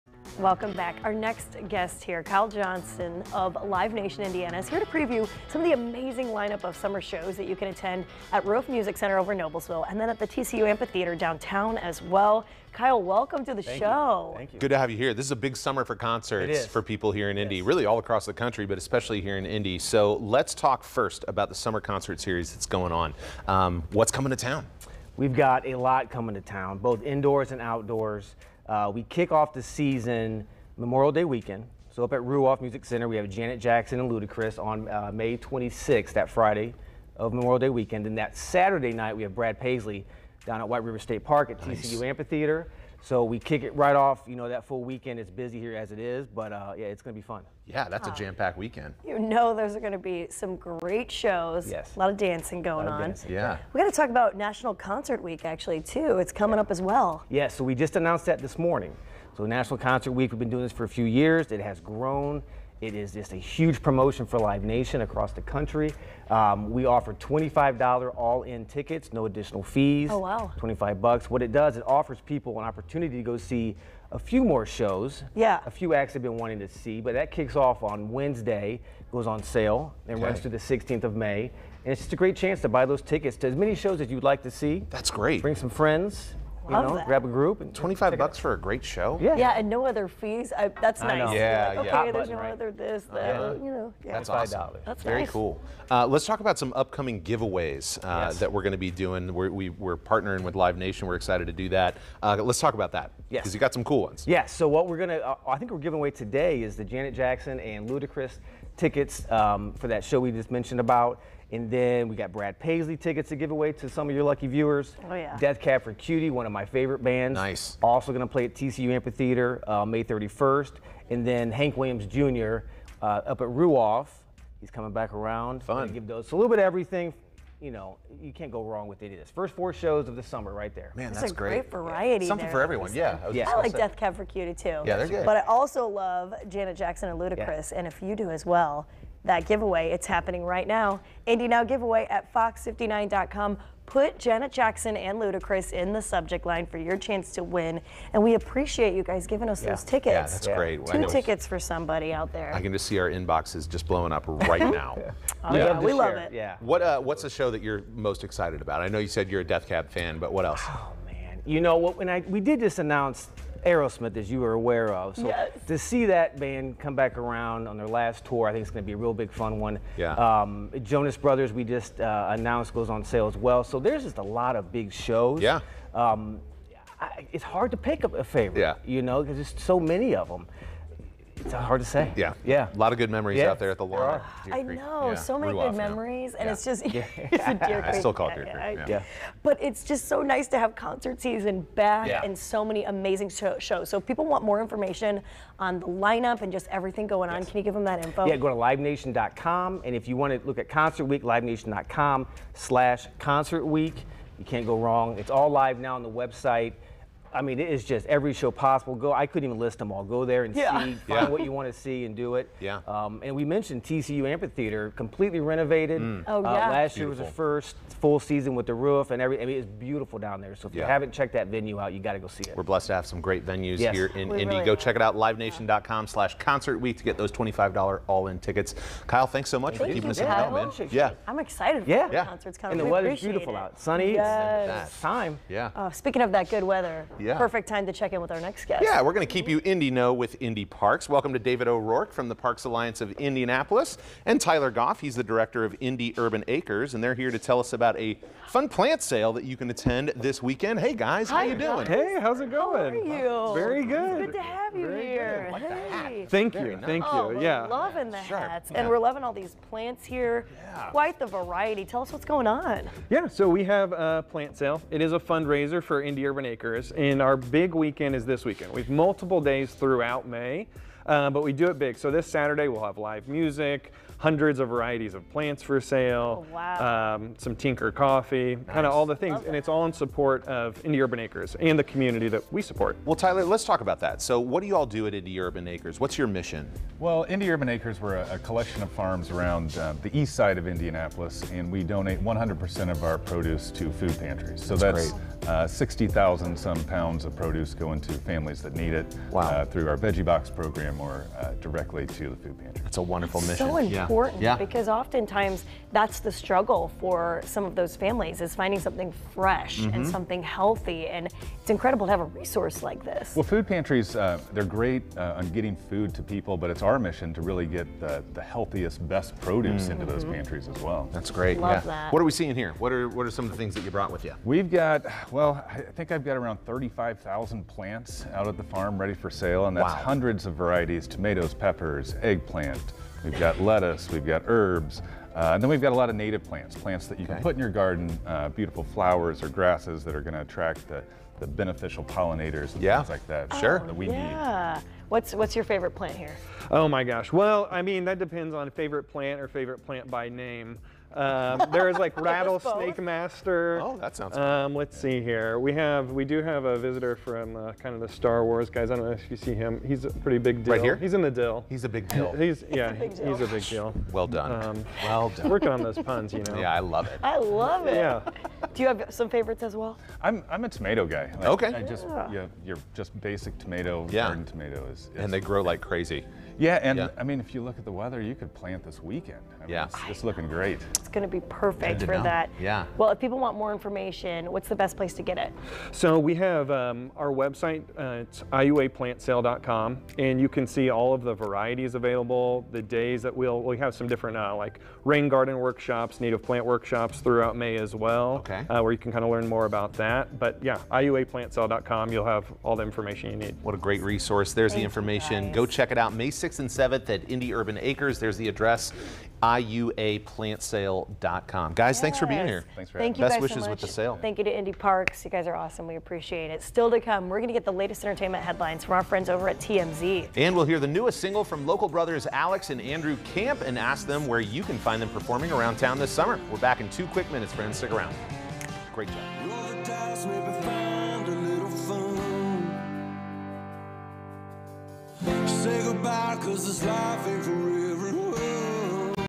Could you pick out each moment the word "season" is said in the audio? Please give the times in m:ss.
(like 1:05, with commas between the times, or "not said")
0:29, 3:11, 3:38.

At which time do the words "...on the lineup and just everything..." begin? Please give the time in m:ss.
3:15.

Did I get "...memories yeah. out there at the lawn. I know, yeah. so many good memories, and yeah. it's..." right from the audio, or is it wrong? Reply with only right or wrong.
right.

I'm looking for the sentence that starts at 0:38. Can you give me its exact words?
And that Saturday night, we have Brad Paisley down at White River State Park at nice.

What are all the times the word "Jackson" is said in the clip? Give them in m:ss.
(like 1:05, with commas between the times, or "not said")
0:33, 1:47, 2:16, 2:24.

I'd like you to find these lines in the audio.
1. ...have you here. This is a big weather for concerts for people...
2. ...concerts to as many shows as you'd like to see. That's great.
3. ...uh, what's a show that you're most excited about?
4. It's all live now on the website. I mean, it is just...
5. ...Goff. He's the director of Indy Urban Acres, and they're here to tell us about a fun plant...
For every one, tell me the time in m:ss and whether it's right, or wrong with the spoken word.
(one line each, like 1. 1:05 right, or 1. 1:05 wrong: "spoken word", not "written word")
1. 0:14 wrong: "summer", not "weather"
2. 1:23 wrong: "tickets", not "concerts"
3. 2:36 right
4. 3:25 right
5. 4:04 right.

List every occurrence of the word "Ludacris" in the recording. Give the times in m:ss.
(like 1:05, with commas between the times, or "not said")
0:34, 1:47, 2:17, 2:25.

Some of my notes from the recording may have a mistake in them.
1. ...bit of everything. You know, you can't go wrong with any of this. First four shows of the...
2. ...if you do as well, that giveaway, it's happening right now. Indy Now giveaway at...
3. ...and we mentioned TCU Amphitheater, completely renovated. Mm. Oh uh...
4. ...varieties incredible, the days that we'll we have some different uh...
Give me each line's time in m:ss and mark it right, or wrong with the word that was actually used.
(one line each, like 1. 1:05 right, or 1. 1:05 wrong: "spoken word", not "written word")
1. 2:06 right
2. 2:17 right
3. 3:33 right
4. 6:31 wrong: "available", not "incredible".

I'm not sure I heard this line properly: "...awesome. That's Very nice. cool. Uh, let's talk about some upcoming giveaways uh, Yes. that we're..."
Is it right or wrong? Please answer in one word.
right.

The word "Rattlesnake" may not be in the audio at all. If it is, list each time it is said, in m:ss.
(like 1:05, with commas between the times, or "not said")
5:52.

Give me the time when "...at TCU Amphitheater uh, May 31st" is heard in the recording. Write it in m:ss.
1:58.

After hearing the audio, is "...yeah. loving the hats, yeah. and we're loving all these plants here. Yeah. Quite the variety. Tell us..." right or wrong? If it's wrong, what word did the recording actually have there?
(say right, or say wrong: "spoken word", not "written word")
right.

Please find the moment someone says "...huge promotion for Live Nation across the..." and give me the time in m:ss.
1:03.